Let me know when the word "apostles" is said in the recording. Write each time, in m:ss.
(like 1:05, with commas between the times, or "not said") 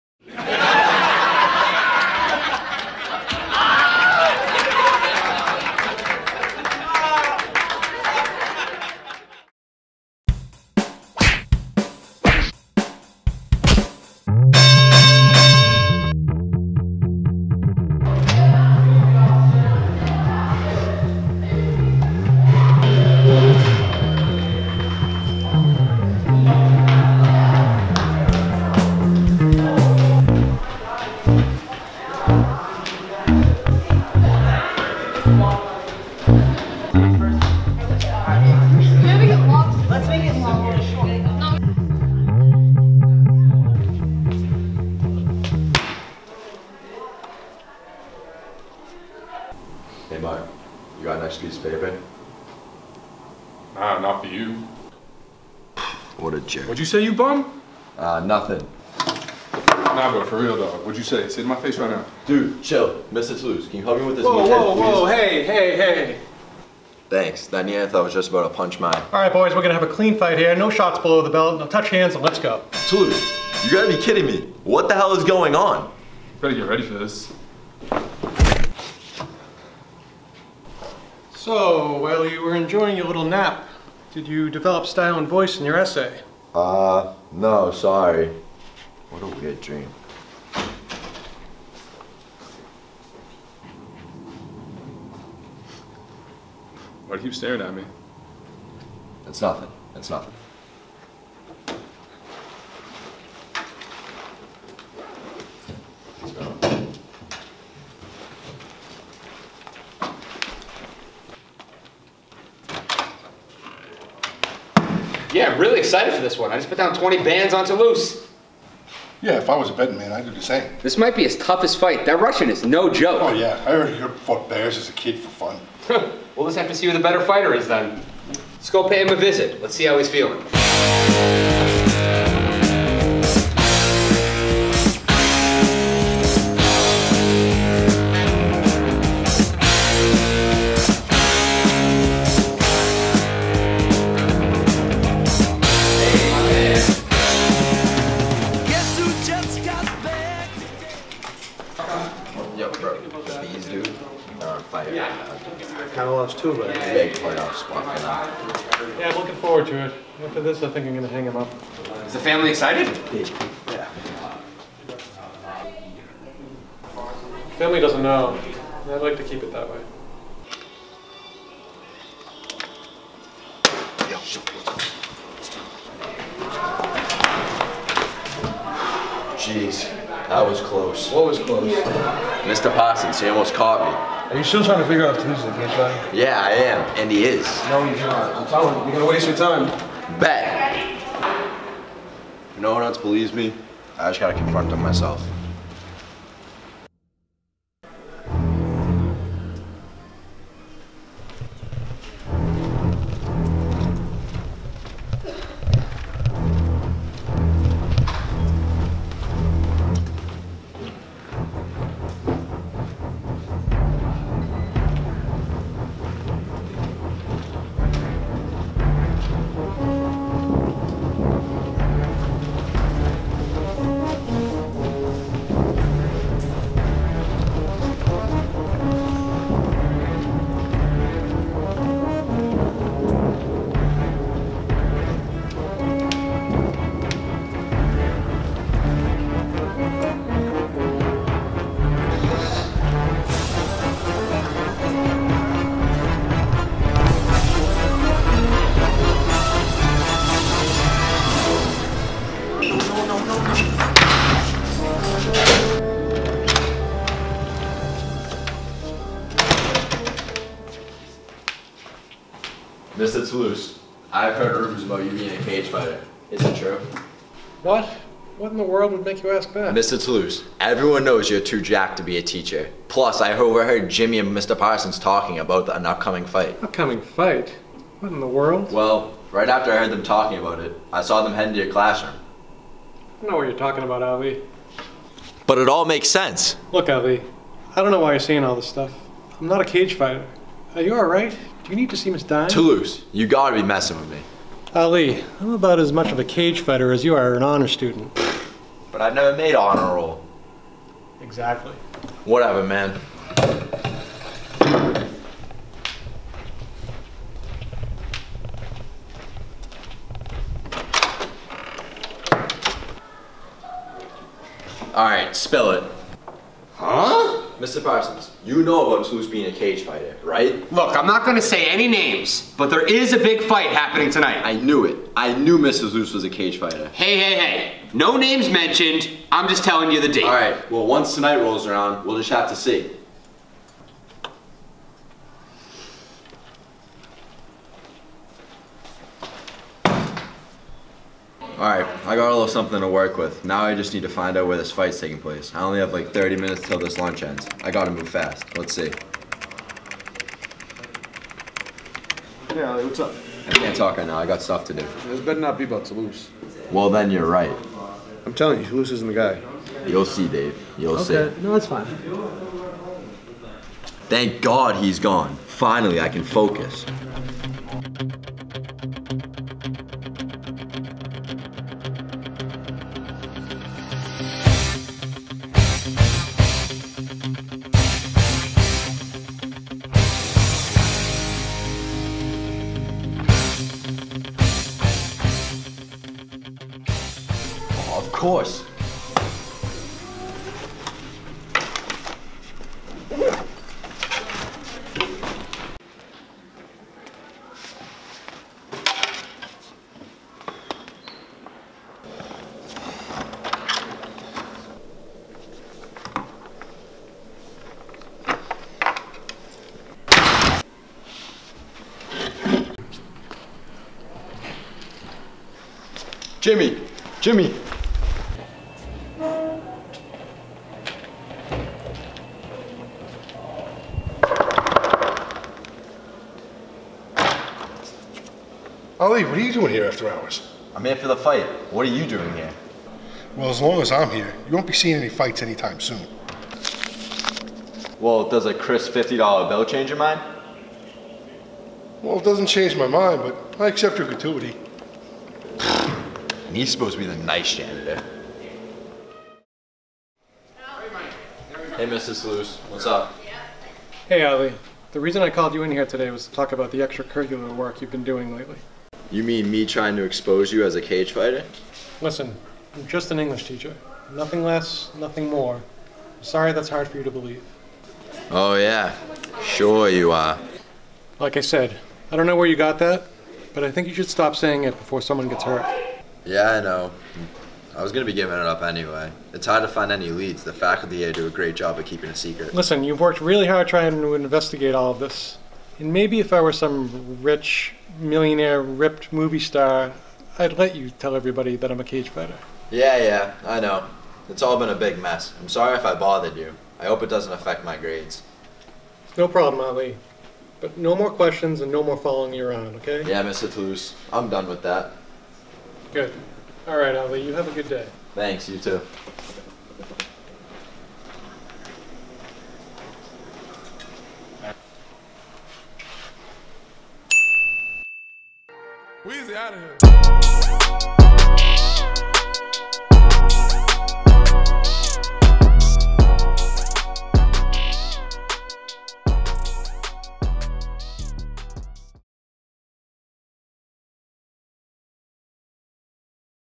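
not said.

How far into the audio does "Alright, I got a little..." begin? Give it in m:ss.
5:41.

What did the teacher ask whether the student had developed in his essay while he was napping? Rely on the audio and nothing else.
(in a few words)
style and voice.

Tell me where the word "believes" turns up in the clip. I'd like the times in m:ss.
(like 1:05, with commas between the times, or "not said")
3:12, 7:47.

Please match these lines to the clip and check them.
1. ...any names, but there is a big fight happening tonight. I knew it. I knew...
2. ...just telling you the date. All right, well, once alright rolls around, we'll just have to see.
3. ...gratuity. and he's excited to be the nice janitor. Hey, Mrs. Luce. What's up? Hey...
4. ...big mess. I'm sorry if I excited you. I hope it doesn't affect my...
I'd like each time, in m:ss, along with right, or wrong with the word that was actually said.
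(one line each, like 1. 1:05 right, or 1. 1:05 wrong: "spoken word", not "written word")
1. 5:21 right
2. 5:29 wrong: "tonight", not "alright"
3. 7:24 wrong: "supposed", not "excited"
4. 8:14 wrong: "bothered", not "excited".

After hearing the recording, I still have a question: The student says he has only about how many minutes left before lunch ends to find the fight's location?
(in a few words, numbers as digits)
30 minutes.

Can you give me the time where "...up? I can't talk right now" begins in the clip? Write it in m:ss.
5:52.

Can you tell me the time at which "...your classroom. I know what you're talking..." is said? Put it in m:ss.
4:41.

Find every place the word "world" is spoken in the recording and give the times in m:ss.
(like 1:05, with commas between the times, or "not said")
4:28, 4:38.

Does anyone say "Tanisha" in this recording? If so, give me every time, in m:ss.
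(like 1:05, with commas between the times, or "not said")
3:05.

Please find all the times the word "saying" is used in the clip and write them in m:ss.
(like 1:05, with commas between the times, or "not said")
4:48, 7:54.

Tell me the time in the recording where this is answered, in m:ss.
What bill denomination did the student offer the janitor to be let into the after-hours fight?
7:18.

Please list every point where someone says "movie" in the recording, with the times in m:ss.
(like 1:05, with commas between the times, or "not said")
8:09.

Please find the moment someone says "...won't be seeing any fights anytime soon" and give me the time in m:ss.
7:14.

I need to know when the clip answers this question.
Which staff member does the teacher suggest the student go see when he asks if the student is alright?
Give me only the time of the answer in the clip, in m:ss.
4:52.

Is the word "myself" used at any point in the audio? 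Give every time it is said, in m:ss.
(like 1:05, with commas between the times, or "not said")
3:14.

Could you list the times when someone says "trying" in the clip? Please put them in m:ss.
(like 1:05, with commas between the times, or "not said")
3:04, 7:39, 8:03.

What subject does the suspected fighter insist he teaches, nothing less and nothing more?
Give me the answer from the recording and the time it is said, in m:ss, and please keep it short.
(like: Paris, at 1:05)
English, at 7:43.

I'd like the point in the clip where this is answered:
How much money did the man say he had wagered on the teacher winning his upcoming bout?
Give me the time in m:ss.
1:56.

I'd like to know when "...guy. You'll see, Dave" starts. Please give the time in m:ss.
5:59.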